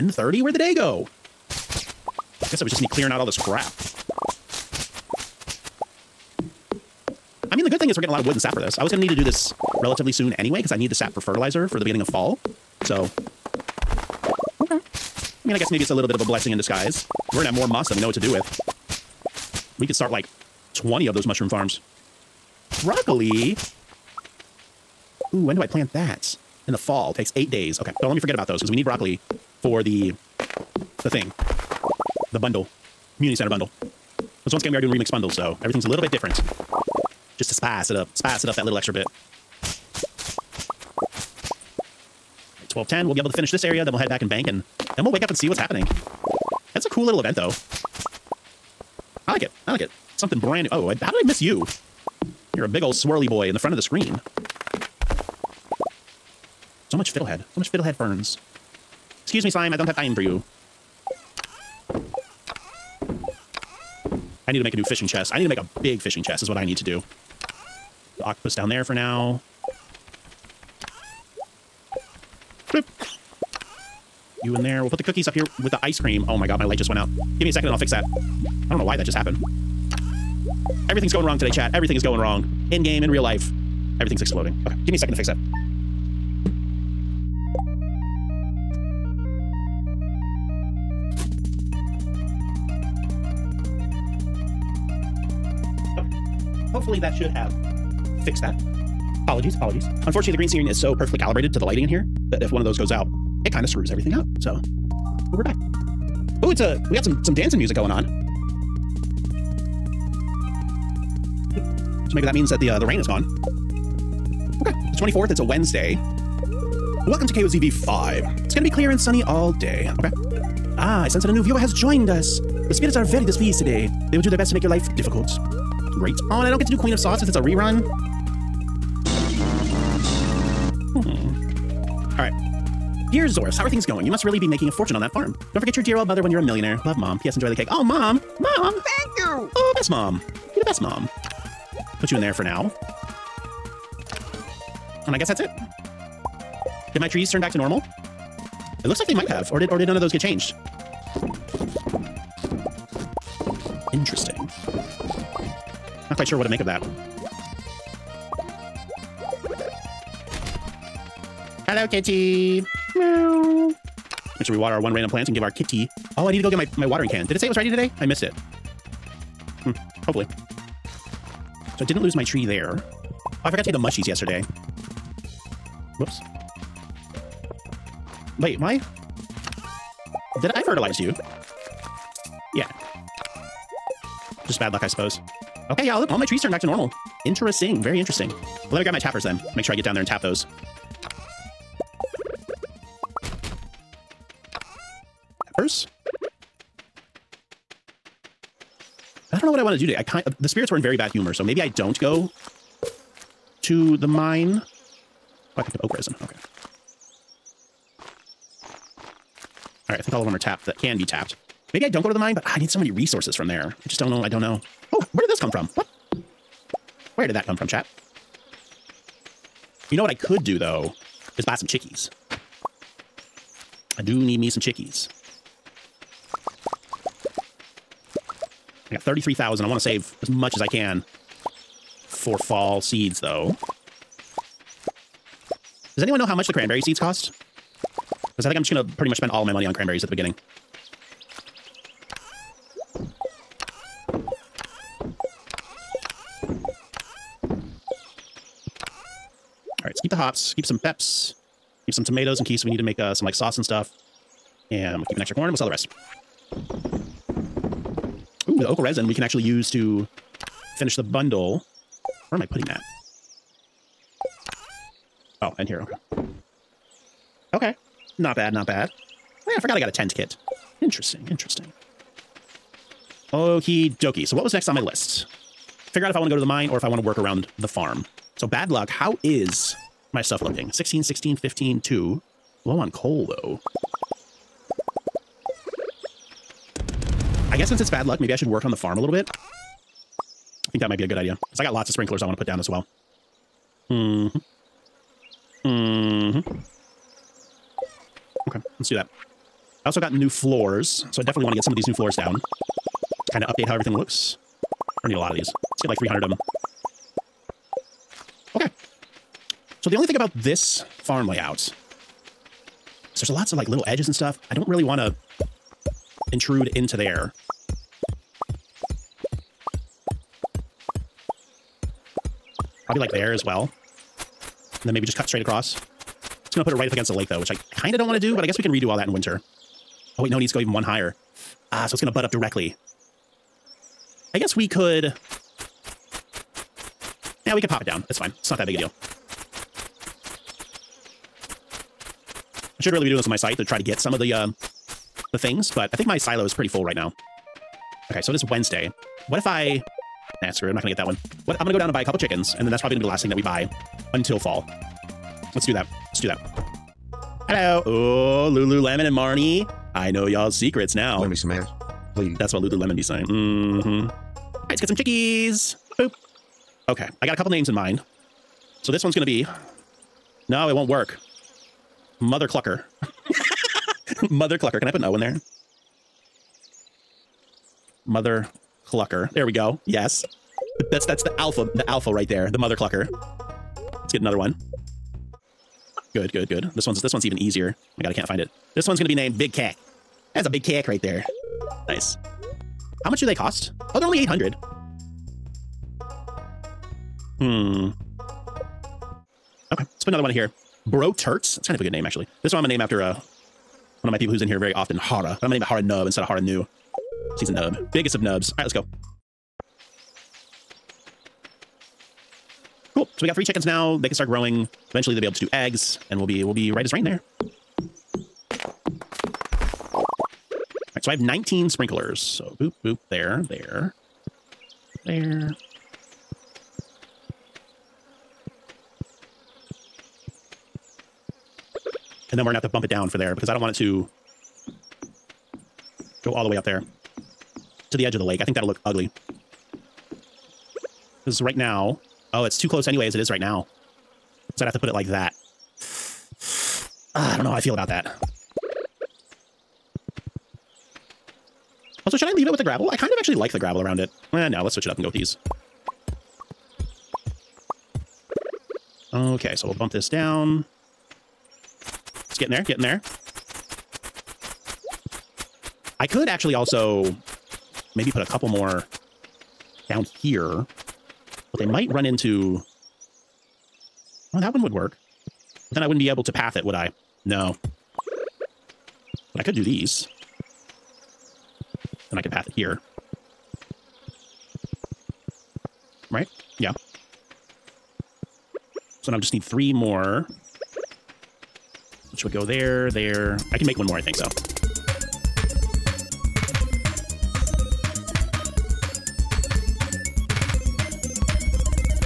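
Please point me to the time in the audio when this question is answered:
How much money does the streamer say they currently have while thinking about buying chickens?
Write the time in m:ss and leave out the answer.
3:49.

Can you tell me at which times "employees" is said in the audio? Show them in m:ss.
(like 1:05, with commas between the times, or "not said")
not said.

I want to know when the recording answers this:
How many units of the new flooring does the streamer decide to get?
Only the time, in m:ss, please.
5:05.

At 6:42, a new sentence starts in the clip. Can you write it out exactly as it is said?
This one I'm gonna name after uh, one of my people who's in here very often, Hara.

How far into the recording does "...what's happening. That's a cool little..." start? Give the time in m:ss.
0:45.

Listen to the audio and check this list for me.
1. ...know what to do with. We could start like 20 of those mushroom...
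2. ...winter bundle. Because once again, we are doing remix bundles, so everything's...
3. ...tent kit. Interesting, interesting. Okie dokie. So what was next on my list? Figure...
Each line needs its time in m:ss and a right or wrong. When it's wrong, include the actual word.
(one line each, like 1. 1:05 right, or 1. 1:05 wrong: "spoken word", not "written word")
1. 0:18 right
2. 0:33 wrong: "center", not "winter"
3. 4:29 right.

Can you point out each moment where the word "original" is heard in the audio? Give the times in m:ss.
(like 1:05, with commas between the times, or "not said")
not said.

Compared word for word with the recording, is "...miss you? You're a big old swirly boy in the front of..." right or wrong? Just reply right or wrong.
right.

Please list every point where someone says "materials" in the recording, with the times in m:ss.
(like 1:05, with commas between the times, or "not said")
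not said.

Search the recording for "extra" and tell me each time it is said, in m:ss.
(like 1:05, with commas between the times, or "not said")
0:38, 4:15.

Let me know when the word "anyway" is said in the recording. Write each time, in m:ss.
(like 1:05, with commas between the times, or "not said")
0:10, 7:22.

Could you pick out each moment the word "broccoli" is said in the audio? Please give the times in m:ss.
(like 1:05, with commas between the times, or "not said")
0:22, 0:28.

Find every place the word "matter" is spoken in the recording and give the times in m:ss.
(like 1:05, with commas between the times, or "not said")
not said.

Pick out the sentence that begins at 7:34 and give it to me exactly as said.
Eh, no, let's switch it up and go with these.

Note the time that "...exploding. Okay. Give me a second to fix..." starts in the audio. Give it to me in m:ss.
1:24.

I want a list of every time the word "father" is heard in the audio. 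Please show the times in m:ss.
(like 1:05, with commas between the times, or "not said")
not said.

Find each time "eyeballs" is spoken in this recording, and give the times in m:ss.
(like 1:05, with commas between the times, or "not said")
not said.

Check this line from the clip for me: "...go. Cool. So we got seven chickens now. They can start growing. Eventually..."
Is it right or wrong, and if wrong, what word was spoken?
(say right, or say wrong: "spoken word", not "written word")
wrong: "three", not "seven".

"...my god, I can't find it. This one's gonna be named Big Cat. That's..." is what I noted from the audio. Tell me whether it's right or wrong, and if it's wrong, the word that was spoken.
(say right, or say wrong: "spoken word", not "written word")
right.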